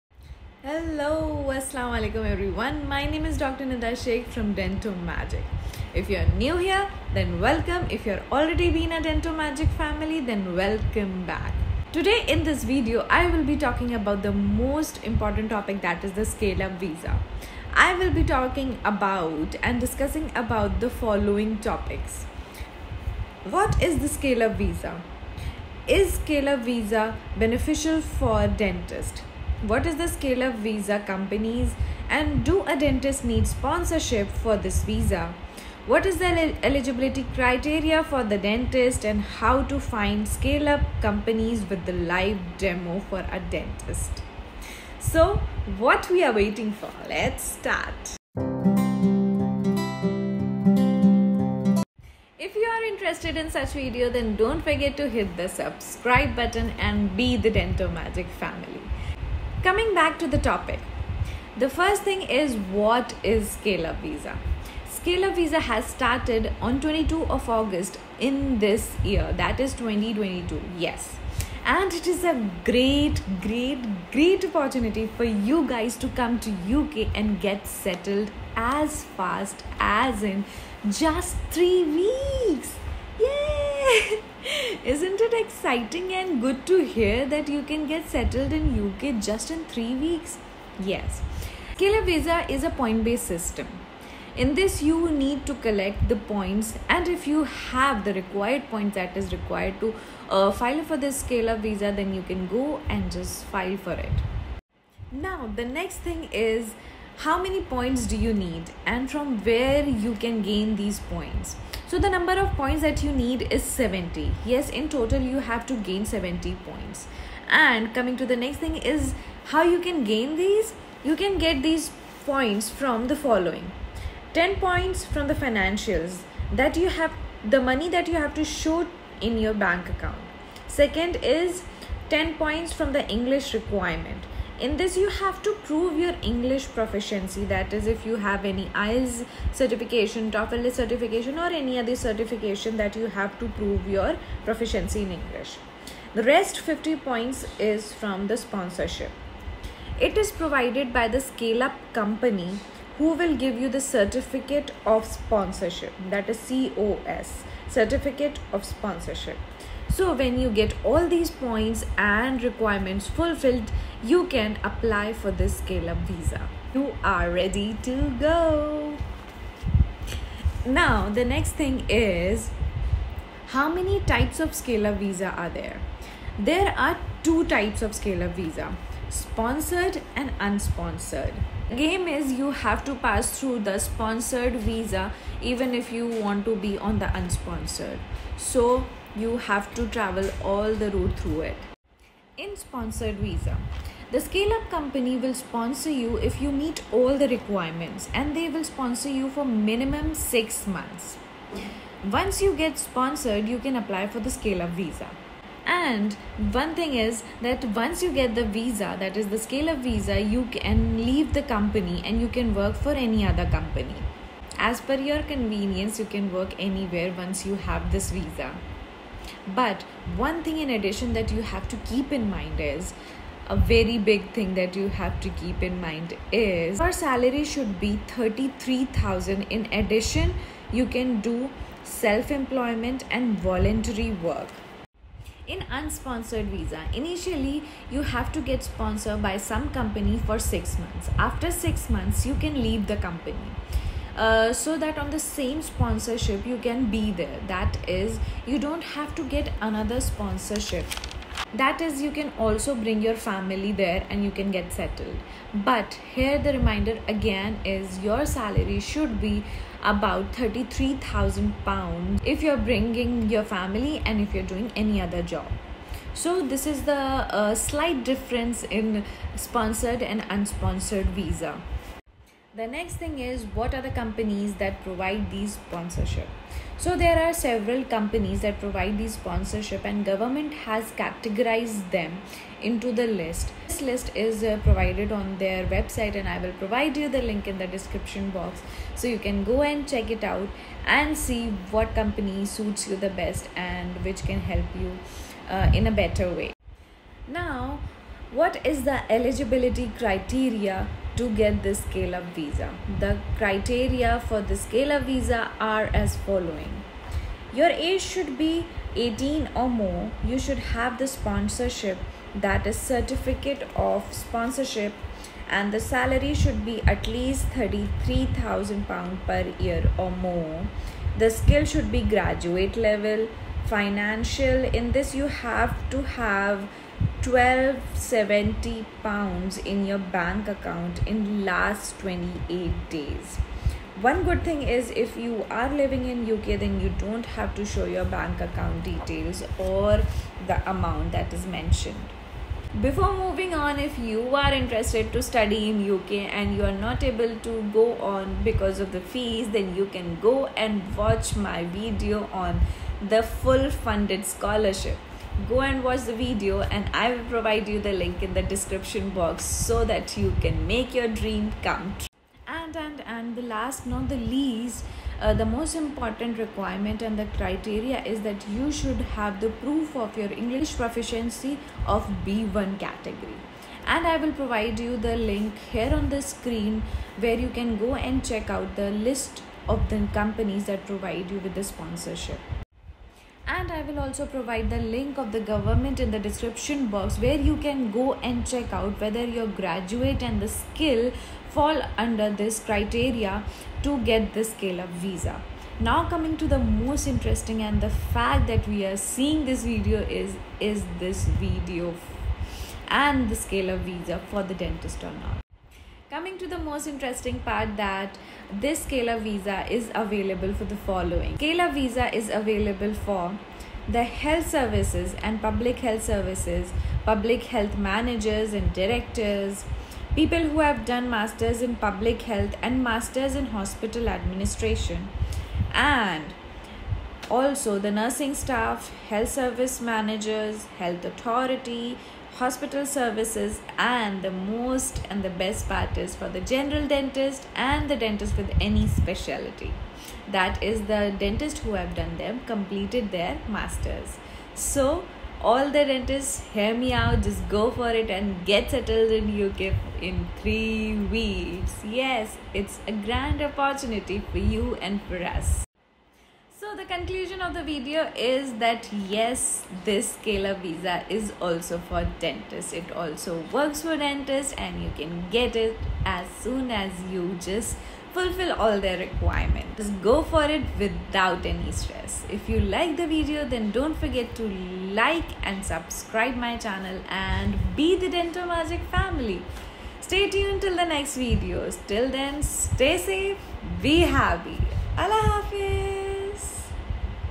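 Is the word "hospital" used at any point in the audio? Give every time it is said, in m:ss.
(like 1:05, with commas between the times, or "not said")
7:03, 7:12.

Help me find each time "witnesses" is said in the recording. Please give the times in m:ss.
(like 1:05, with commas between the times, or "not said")
not said.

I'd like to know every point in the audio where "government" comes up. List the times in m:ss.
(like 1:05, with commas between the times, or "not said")
4:40, 6:25.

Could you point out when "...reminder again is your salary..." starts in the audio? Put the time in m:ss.
4:16.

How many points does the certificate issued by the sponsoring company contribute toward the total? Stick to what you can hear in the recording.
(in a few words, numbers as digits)
50.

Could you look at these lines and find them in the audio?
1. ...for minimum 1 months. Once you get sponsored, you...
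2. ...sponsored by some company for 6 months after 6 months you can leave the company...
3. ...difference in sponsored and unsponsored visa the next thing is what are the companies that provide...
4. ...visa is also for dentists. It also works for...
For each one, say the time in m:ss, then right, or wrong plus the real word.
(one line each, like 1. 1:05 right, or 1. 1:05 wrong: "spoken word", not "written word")
1. 3:19 wrong: "6", not "1"
2. 3:58 right
3. 4:28 right
4. 7:40 right.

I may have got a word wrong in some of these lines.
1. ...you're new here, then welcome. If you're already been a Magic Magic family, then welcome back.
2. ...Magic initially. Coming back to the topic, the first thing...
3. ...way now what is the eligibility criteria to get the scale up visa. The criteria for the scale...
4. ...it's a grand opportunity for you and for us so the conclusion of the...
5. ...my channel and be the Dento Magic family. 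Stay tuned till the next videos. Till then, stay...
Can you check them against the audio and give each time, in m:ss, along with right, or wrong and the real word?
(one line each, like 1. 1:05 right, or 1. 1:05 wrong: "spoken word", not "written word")
1. 0:06 wrong: "Dento", not "Magic"
2. 0:57 wrong: "family", not "initially"
3. 4:56 right
4. 7:32 right
5. 7:56 right.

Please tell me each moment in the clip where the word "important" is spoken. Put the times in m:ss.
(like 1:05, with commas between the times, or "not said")
0:15, 6:05.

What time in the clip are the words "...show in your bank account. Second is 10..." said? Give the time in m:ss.
2:08.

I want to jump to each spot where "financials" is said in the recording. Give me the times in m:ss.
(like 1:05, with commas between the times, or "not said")
2:05, 5:23.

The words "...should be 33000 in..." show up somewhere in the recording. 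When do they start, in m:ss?
3:47.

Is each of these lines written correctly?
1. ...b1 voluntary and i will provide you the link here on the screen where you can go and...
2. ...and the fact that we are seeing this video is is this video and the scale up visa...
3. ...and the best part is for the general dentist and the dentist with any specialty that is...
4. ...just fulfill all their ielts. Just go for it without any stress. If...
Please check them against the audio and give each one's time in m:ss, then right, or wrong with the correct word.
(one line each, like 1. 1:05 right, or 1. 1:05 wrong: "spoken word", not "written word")
1. 6:12 wrong: "category", not "voluntary"
2. 6:37 right
3. 7:15 right
4. 7:47 wrong: "requirements", not "ielts".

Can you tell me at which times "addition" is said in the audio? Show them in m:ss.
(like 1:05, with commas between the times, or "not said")
3:40, 3:49.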